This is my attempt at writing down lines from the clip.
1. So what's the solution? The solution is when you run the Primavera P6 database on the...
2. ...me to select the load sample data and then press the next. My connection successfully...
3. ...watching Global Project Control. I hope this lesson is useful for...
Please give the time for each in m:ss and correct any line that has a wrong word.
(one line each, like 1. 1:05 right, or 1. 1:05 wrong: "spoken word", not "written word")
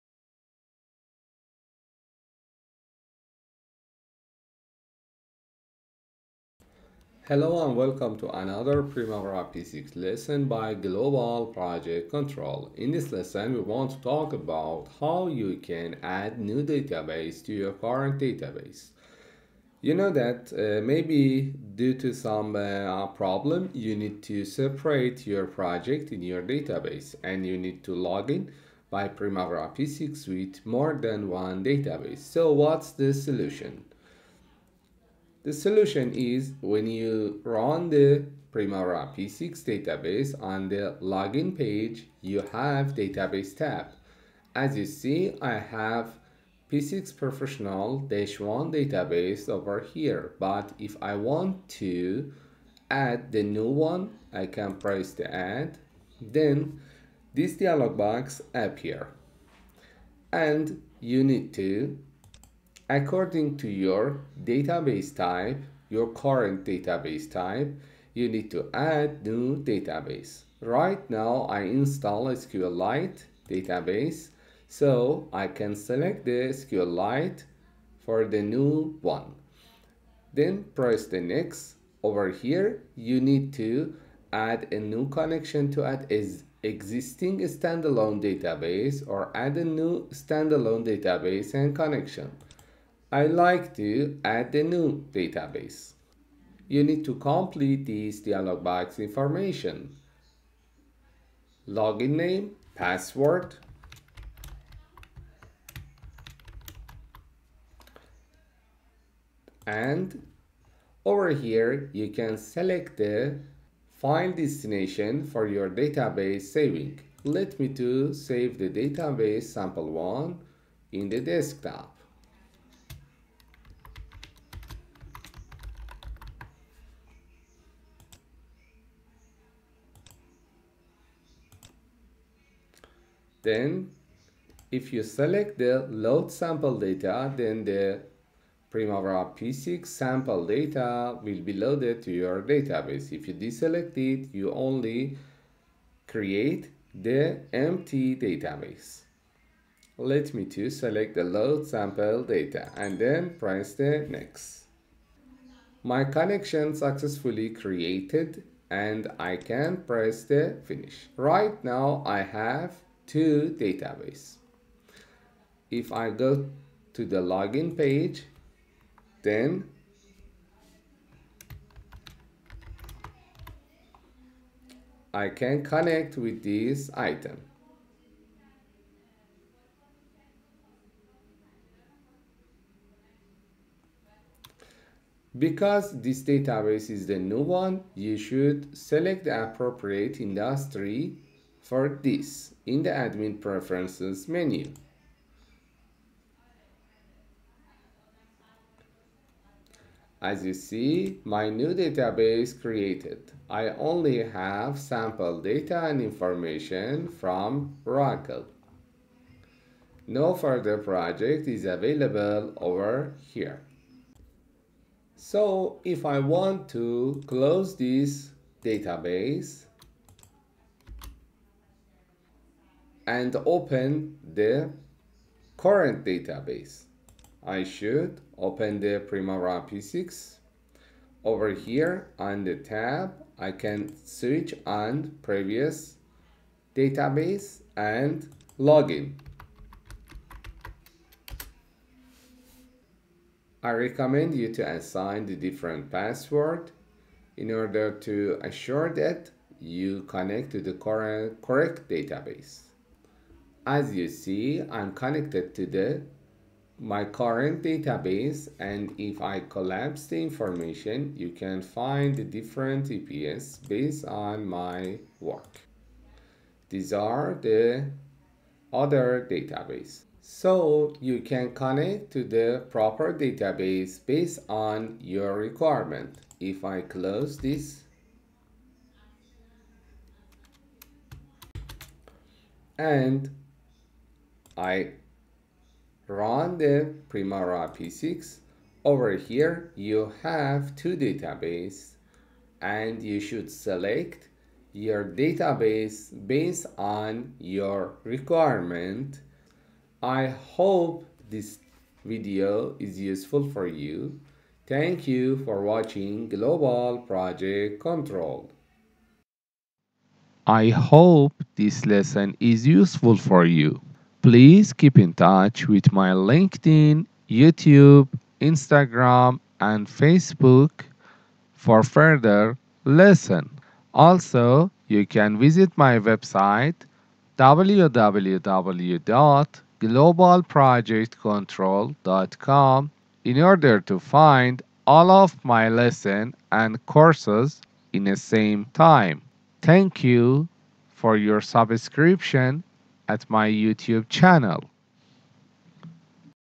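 1. 0:32 right
2. 2:30 right
3. 5:05 right.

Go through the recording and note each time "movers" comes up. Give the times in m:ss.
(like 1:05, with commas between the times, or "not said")
not said.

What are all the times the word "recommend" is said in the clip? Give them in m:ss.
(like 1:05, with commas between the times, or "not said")
4:03.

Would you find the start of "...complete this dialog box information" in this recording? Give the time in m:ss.
1:37.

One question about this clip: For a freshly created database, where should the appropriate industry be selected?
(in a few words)
admin preferences.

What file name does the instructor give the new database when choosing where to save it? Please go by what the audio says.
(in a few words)
sample1.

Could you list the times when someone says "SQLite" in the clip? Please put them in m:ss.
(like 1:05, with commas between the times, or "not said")
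1:12, 1:16.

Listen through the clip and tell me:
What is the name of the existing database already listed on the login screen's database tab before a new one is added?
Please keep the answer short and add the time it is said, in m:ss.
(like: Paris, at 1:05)
P6 Professional-1, at 0:46.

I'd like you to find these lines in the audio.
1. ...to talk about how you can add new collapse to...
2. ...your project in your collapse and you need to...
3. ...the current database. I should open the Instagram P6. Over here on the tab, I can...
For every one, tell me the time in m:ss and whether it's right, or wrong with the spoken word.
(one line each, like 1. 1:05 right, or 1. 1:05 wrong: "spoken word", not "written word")
1. 0:13 wrong: "database", not "collapse"
2. 0:25 wrong: "database", not "collapse"
3. 3:44 wrong: "Primavera", not "Instagram".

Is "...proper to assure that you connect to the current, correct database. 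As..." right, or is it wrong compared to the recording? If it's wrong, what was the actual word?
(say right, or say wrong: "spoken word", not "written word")
wrong: "order", not "proper".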